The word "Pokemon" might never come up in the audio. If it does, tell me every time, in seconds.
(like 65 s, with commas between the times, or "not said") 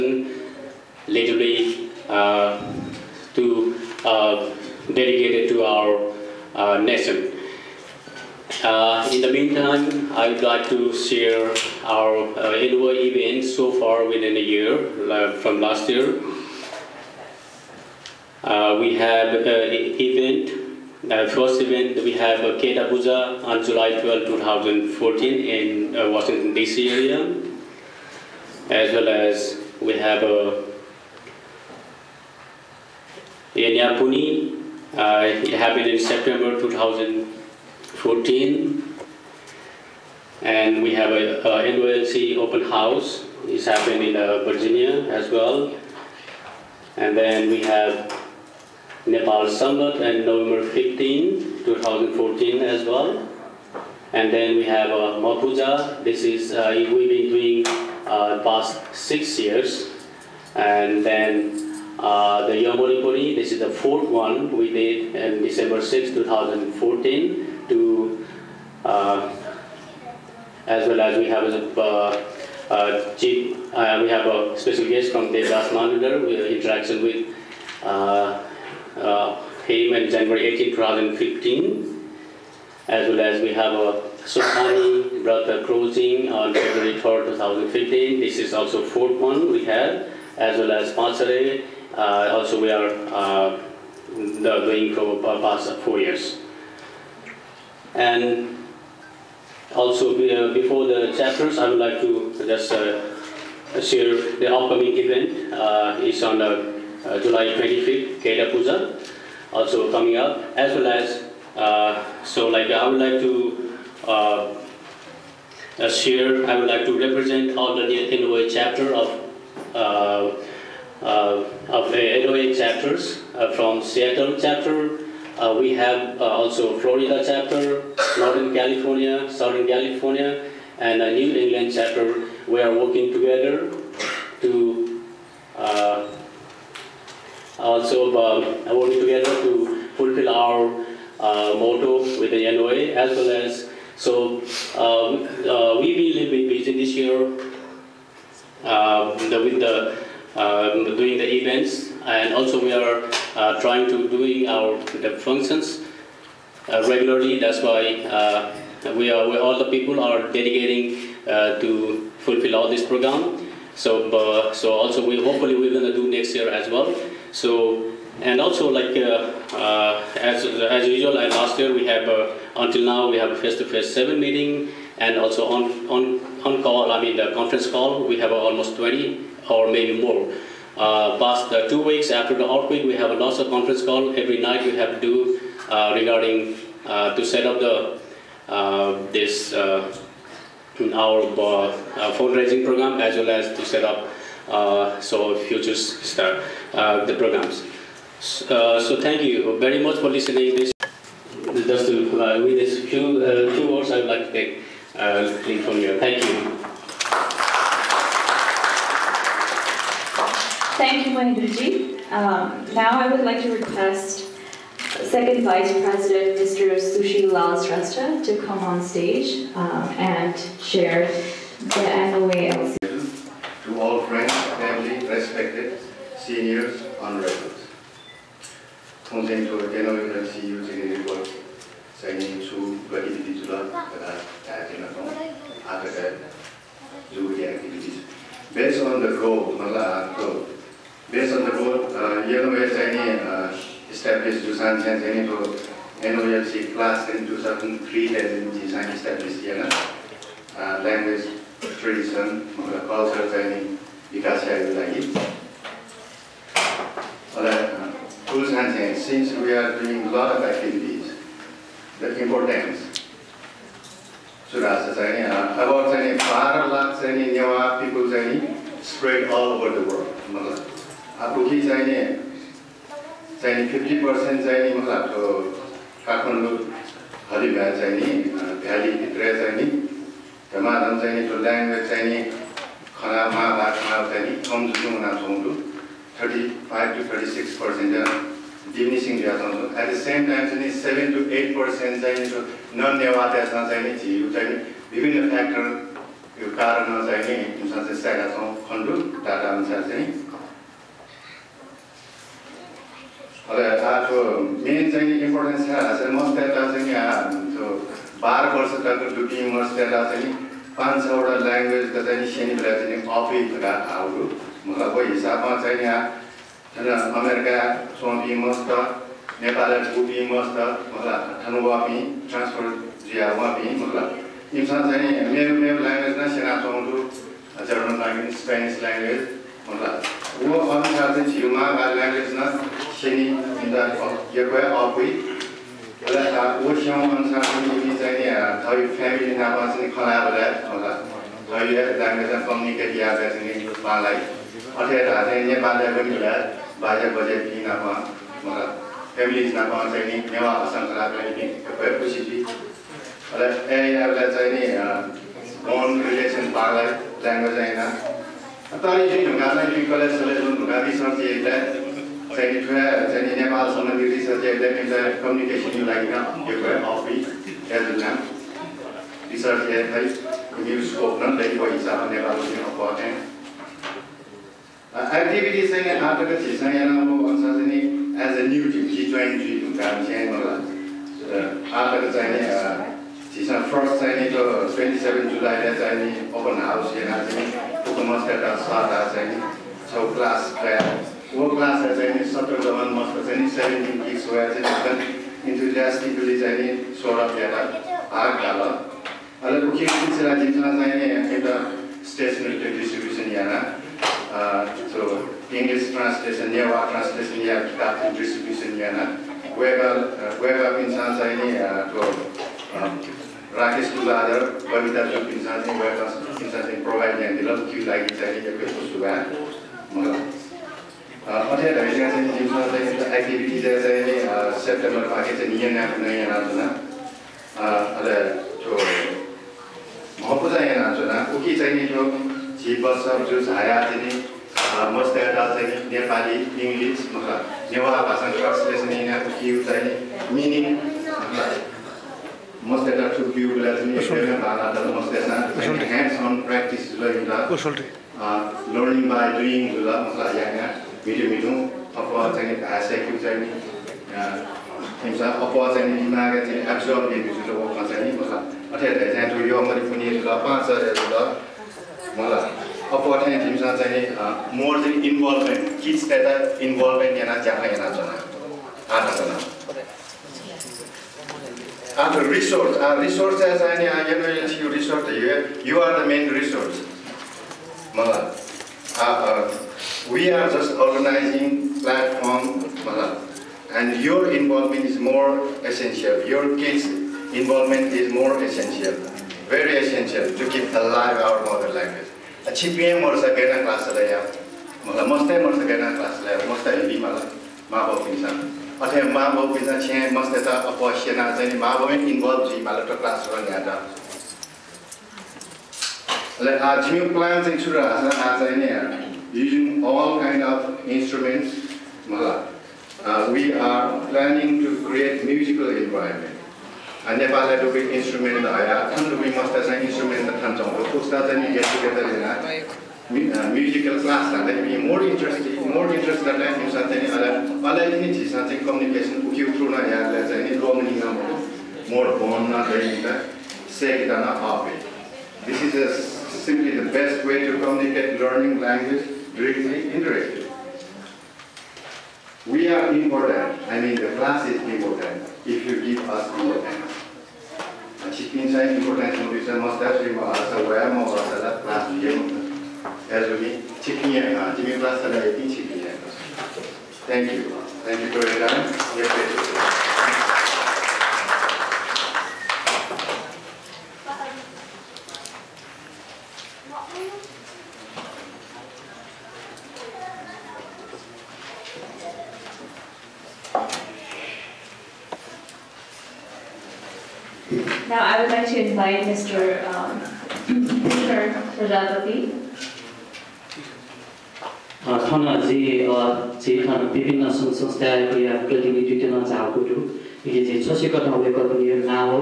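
387 s.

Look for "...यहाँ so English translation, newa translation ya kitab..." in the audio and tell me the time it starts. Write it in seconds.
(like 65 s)
403 s.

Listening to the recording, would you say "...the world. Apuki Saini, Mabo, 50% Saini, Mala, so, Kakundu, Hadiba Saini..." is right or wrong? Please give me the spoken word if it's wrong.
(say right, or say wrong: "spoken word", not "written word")
wrong: "Saini", not "Mabo".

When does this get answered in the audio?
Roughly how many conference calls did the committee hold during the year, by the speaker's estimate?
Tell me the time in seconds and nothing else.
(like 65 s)
178 s.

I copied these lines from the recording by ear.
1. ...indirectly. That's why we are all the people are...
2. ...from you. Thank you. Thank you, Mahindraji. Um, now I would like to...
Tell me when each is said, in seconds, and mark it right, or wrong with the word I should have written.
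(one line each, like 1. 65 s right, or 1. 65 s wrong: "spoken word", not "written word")
1. 156 s wrong: "regularly", not "indirectly"
2. 205 s right.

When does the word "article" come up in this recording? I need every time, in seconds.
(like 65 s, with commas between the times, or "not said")
376 s, 381 s.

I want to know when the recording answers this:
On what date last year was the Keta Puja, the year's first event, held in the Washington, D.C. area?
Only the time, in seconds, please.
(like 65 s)
23 s.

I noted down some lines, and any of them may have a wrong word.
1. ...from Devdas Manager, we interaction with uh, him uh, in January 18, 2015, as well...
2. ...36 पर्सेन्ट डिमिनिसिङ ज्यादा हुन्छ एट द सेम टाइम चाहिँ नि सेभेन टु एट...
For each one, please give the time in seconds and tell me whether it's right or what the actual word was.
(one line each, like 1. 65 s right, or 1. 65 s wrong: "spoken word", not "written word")
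1. 75 s right
2. 287 s right.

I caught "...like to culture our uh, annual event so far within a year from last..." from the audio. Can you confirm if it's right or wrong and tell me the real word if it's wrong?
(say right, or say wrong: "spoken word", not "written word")
wrong: "share", not "culture".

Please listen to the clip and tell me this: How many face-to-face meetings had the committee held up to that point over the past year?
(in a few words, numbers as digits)
7.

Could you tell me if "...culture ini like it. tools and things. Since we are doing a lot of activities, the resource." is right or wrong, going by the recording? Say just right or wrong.
wrong.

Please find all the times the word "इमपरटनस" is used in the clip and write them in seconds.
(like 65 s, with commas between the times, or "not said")
305 s, 548 s.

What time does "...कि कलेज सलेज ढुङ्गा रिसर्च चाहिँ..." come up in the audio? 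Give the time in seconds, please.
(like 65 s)
359 s.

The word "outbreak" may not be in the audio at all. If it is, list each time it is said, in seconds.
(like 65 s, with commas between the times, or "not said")
182 s.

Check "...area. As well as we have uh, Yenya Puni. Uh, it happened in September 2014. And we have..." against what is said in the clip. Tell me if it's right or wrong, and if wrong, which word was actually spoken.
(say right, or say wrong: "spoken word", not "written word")
right.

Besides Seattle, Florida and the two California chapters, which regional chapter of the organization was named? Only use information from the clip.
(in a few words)
New England.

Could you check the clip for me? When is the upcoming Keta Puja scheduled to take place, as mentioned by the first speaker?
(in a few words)
July 25th.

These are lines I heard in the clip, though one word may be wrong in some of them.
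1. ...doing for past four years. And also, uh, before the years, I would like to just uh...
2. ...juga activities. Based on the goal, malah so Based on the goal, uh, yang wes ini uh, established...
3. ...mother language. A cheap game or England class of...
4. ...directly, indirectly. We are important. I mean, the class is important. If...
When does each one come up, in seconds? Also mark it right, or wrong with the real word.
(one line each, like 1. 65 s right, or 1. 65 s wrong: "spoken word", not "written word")
1. 94 s wrong: "chapters", not "years"
2. 237 s right
3. 491 s wrong: "Sagana", not "England"
4. 539 s right.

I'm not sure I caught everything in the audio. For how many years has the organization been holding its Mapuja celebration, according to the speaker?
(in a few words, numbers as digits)
6.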